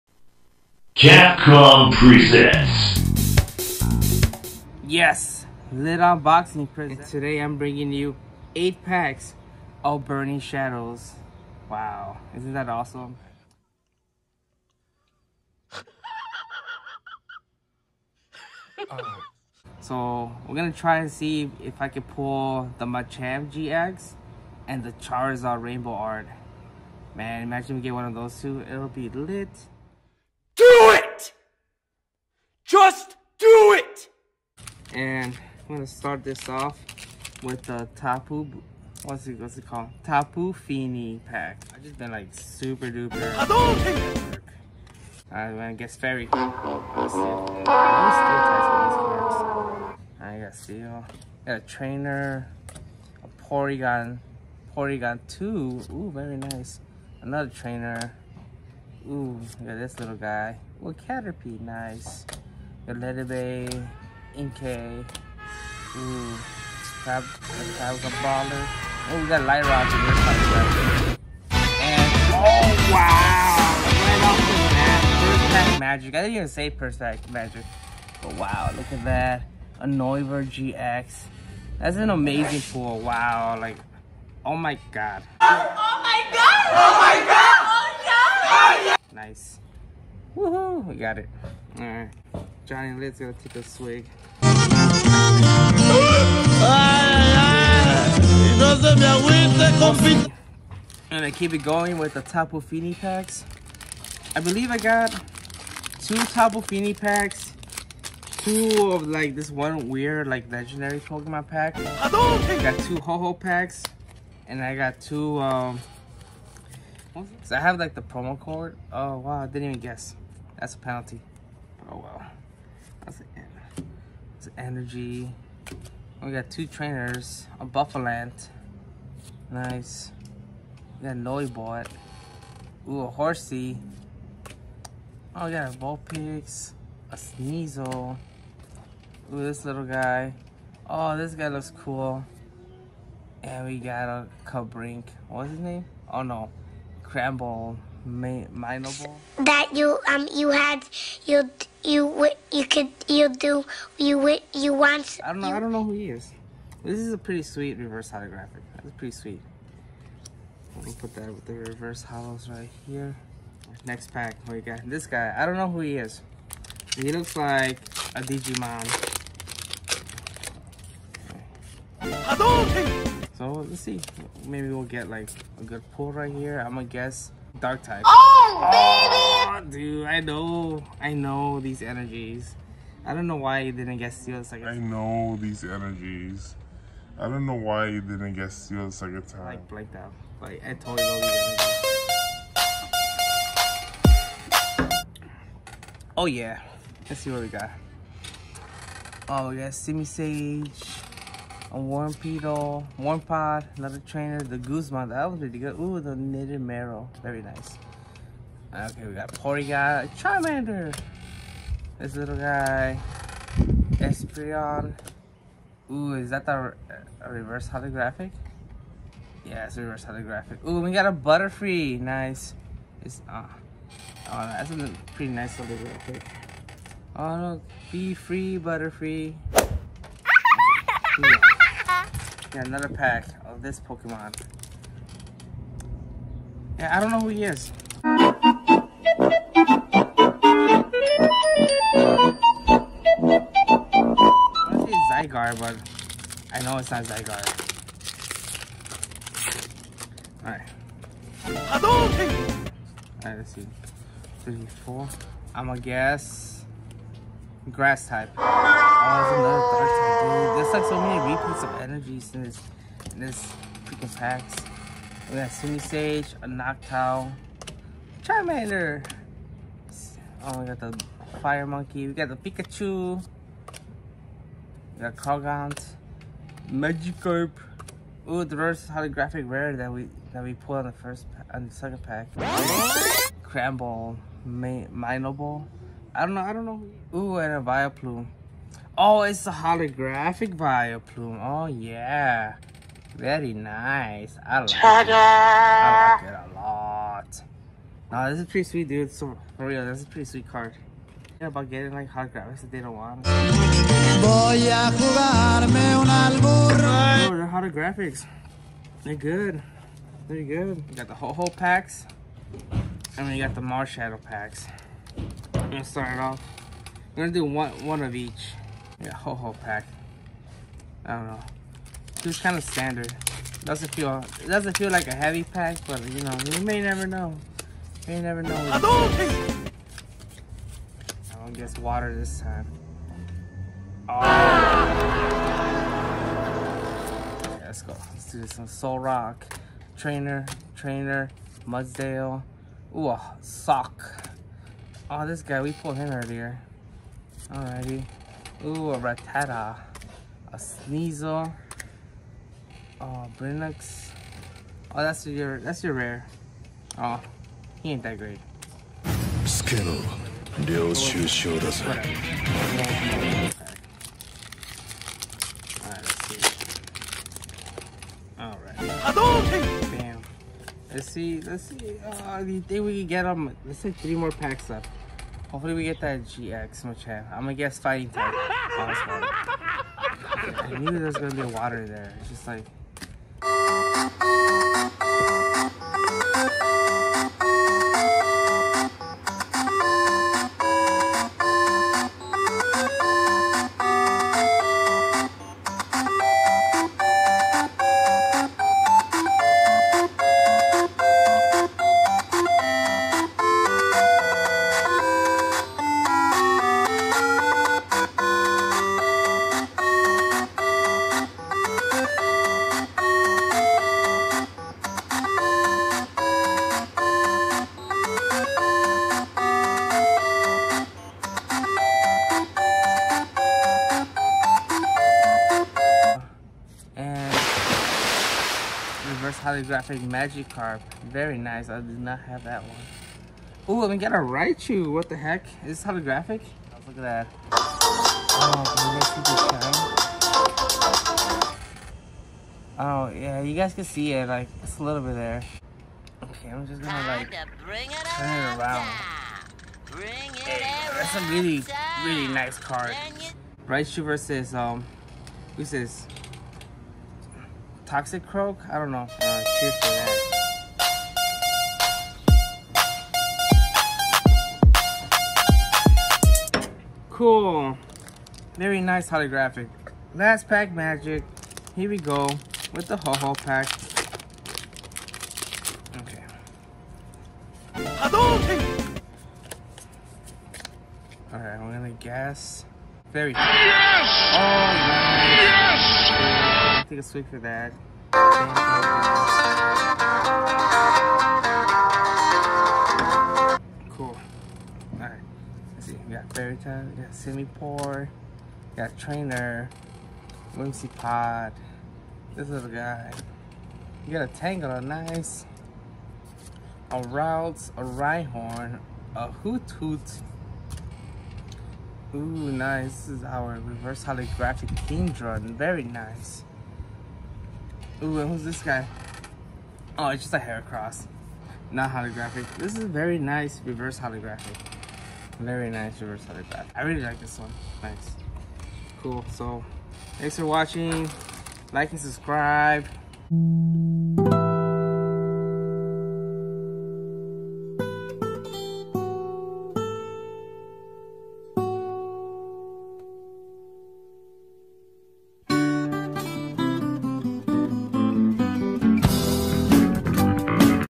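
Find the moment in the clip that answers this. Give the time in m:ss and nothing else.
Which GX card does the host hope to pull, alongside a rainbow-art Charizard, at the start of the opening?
0:22.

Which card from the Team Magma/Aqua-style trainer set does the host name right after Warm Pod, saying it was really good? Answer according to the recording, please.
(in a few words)
Guzman.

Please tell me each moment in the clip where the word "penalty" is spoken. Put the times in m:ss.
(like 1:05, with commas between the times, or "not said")
2:00.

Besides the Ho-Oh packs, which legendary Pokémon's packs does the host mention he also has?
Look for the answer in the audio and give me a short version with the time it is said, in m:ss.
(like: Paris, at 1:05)
Marshadow, at 5:13.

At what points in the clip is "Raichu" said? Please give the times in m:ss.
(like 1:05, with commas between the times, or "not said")
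7:14, 7:33.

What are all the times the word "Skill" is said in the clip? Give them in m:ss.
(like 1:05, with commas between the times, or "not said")
5:59.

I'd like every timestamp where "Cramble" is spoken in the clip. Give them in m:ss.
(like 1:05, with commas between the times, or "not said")
2:27, 4:43.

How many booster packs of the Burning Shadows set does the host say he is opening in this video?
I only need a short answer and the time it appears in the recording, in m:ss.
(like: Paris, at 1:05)
8, at 0:08.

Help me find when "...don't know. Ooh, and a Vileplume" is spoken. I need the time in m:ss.
4:46.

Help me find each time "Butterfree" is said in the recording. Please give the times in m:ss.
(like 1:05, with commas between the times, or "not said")
3:41, 3:48.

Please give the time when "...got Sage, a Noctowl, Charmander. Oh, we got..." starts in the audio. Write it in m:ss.
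4:25.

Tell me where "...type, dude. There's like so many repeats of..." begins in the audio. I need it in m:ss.
4:20.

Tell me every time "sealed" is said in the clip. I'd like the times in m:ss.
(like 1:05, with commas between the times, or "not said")
3:04, 3:08.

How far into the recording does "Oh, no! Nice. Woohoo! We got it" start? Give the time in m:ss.
1:28.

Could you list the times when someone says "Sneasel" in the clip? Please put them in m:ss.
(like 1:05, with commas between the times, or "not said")
2:17, 5:50.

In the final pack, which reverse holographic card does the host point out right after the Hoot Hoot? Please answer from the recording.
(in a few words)
Kingdra.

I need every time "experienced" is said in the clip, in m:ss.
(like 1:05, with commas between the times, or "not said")
not said.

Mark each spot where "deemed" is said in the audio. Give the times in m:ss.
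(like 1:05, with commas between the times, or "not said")
not said.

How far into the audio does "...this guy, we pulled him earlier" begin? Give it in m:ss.
5:45.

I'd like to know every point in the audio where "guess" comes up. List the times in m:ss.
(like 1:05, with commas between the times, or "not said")
1:59, 2:56, 4:15, 6:17, 8:01.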